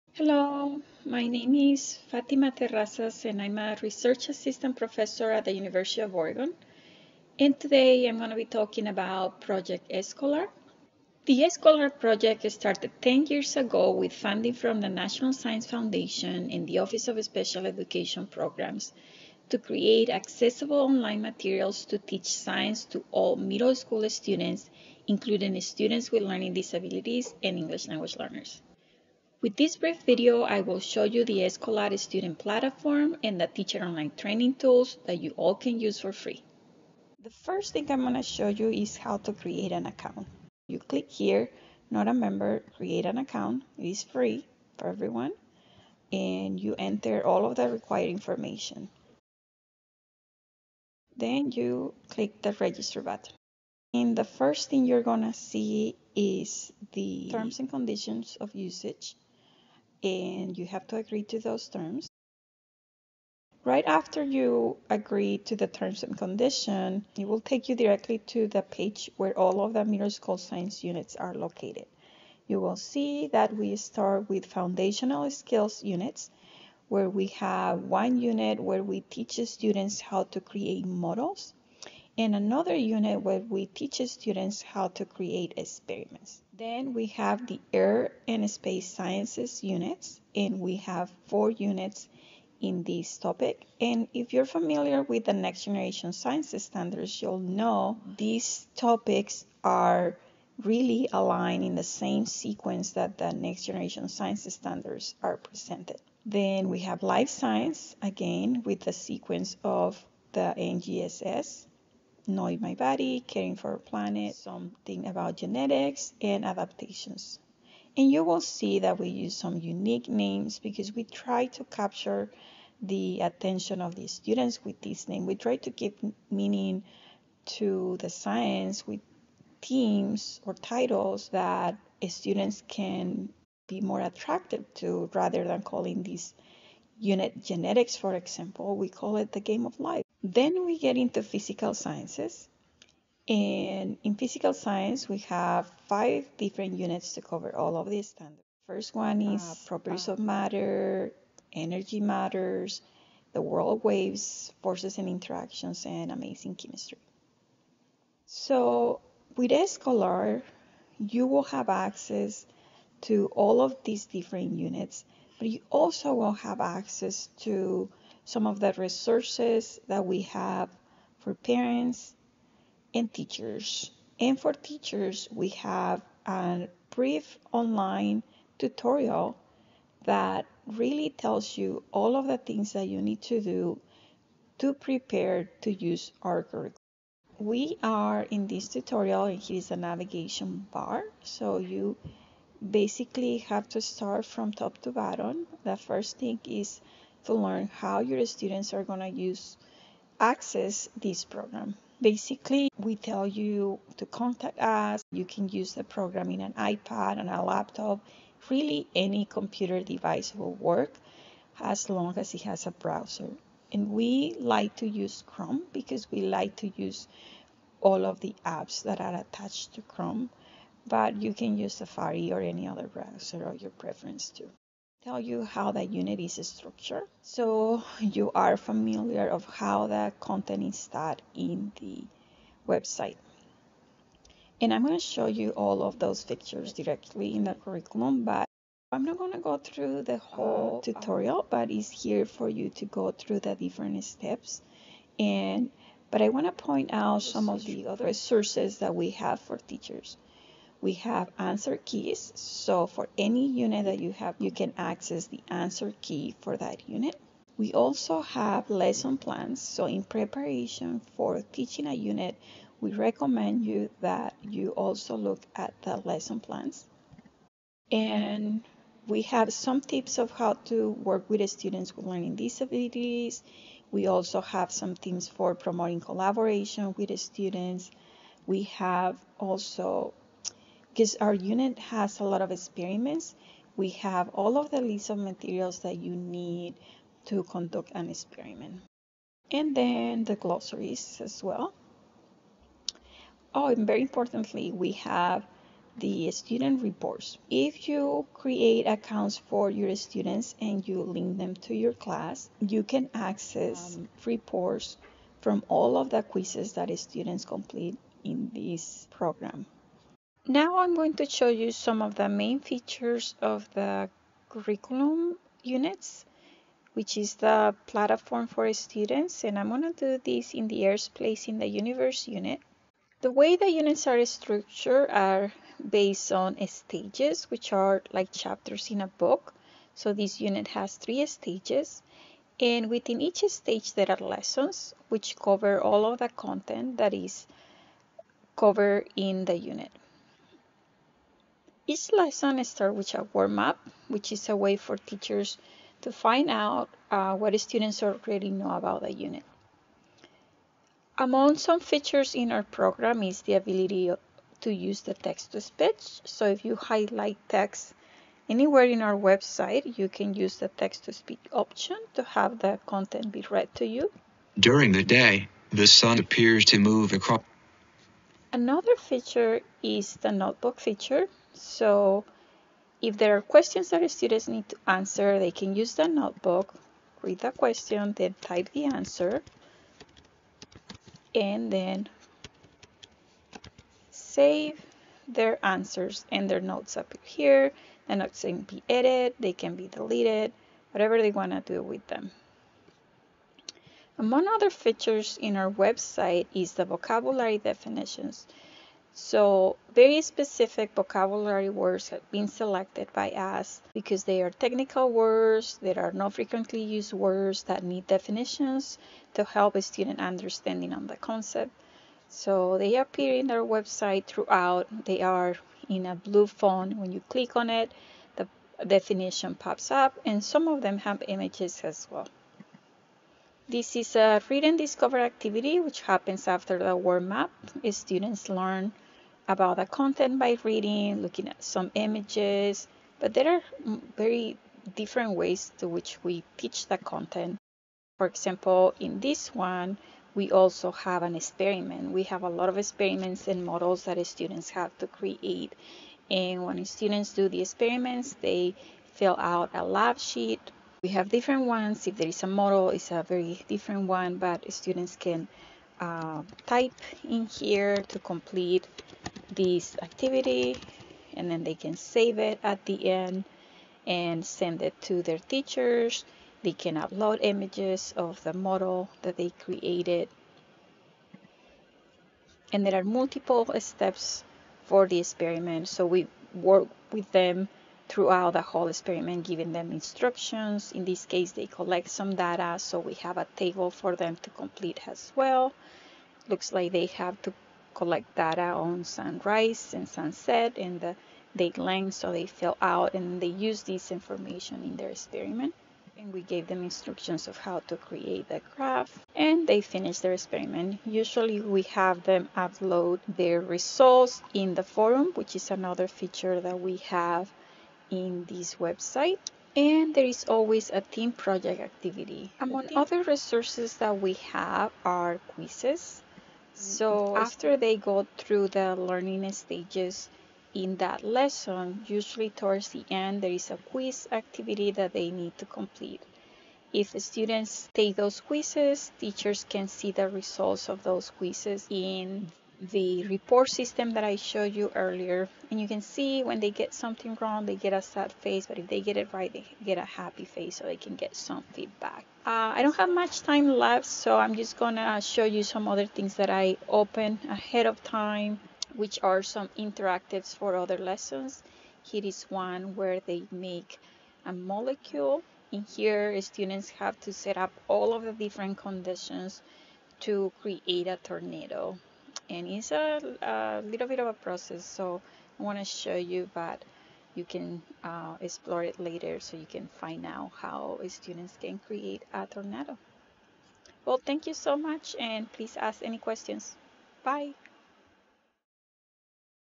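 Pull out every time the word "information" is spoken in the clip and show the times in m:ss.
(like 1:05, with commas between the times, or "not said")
0:48, 8:14.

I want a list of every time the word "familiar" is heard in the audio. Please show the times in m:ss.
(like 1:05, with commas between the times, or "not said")
1:34, 3:48.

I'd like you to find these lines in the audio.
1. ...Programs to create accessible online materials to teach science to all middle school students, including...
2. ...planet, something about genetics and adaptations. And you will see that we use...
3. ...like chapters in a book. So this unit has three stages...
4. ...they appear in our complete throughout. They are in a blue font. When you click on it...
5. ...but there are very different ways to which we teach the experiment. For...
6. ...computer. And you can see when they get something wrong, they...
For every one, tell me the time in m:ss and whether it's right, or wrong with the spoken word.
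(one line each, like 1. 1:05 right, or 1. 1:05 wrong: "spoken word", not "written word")
1. 0:18 right
2. 1:53 right
3. 5:28 right
4. 6:52 wrong: "website", not "complete"
5. 7:13 wrong: "content", not "experiment"
6. 8:54 wrong: "earlier", not "computer".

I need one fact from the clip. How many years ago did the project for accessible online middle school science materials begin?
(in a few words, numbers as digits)
10 years.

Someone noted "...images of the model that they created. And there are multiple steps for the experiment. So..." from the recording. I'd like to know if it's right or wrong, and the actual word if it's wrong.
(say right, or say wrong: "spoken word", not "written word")
right.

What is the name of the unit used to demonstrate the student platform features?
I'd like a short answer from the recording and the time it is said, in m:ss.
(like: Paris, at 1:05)
Earth Place in the Universe, at 5:20.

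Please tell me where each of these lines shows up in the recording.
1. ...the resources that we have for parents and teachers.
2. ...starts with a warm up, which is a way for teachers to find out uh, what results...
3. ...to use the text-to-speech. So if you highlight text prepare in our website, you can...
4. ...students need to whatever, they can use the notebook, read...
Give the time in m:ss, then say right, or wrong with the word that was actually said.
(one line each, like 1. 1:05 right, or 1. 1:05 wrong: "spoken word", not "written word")
1. 2:48 right
2. 5:42 wrong: "students", not "results"
3. 5:54 wrong: "anywhere", not "prepare"
4. 6:14 wrong: "answer", not "whatever".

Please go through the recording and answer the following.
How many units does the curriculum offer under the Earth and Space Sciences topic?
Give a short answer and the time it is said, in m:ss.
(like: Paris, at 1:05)
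4, at 1:31.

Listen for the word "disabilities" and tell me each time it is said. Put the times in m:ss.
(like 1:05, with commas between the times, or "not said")
0:26, 4:32.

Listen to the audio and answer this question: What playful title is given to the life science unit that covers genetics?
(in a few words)
The Game of Life.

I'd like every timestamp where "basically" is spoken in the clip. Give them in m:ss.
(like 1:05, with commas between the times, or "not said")
3:12, 3:22.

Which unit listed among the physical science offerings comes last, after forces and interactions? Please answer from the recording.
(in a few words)
Amazing Chemistry.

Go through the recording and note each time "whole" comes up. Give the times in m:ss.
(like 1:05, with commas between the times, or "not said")
4:00, 7:58.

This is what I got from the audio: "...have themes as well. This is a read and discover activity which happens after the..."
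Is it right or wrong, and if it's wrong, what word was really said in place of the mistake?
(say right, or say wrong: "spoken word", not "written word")
wrong: "images", not "themes".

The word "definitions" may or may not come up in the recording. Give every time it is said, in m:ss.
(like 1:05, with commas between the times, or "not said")
6:37, 6:48, 6:58.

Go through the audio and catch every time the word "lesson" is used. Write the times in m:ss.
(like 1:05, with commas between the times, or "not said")
4:18, 4:25, 5:34, 5:42, 8:41, 9:10.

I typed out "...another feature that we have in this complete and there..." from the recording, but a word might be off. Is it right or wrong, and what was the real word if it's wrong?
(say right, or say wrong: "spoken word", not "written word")
wrong: "website", not "complete".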